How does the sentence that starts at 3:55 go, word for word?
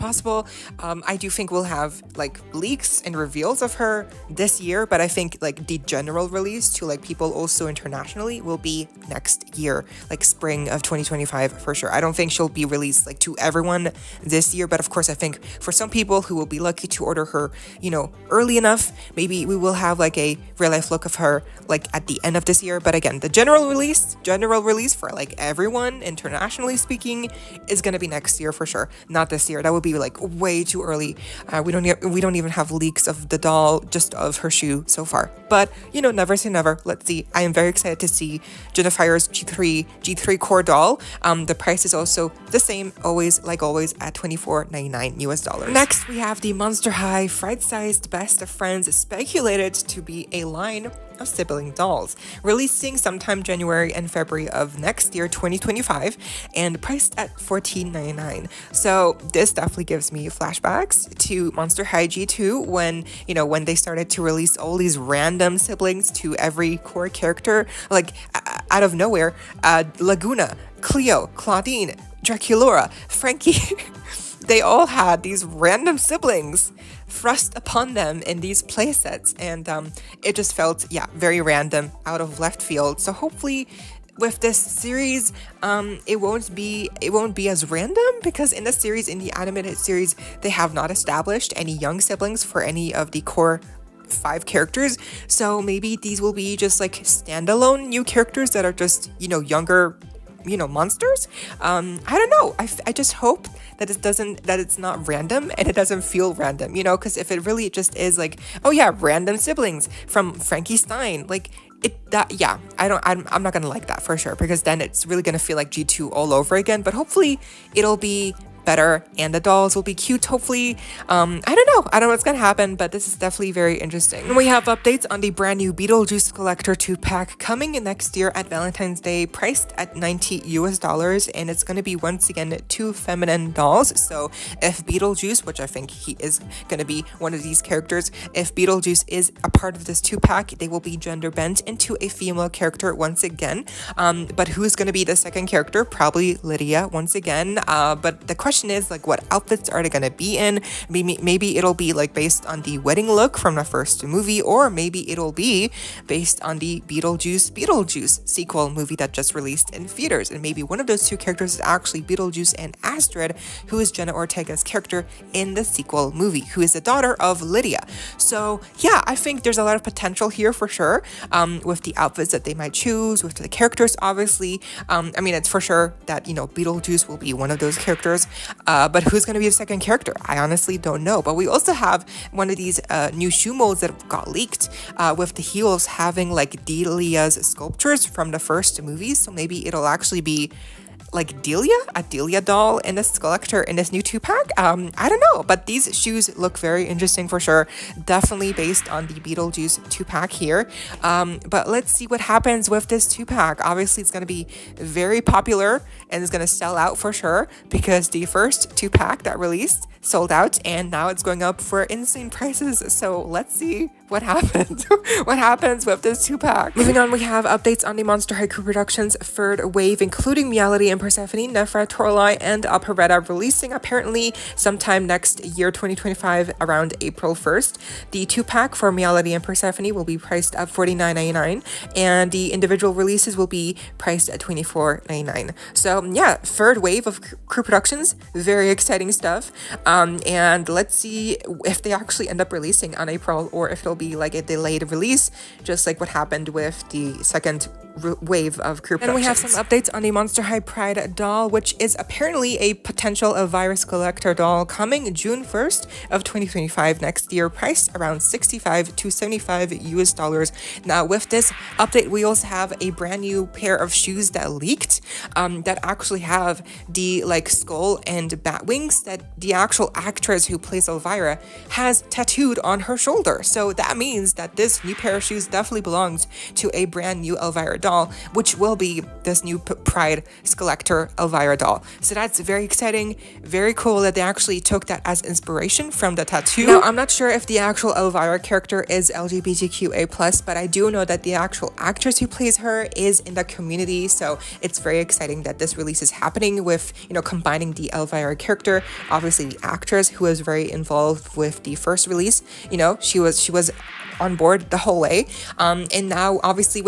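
So, yeah, third wave of crew productions, very exciting stuff.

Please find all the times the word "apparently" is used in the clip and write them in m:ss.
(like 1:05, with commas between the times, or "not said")
3:43, 4:11.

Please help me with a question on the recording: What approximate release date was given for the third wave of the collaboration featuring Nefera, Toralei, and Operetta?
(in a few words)
April 1st.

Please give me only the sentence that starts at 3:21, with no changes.
Um, but let's see what happens with this two pack.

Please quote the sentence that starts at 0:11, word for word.
I don't think she'll be released like to everyone this year.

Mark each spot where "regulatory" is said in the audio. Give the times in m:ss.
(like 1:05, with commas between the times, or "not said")
not said.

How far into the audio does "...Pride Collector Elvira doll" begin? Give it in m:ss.
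4:39.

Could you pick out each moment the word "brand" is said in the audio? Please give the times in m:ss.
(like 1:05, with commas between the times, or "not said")
2:05, 4:22, 4:36.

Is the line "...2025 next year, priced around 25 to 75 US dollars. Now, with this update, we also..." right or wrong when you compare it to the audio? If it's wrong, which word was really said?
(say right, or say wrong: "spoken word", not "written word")
wrong: "65", not "25".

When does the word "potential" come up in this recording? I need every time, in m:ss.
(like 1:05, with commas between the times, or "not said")
2:49, 4:12.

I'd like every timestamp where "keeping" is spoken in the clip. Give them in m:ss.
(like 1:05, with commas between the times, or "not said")
not said.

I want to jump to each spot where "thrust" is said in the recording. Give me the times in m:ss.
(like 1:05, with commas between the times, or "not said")
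1:17.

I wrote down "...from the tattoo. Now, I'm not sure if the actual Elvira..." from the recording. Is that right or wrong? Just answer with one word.
right.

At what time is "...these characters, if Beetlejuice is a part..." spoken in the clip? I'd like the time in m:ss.
2:17.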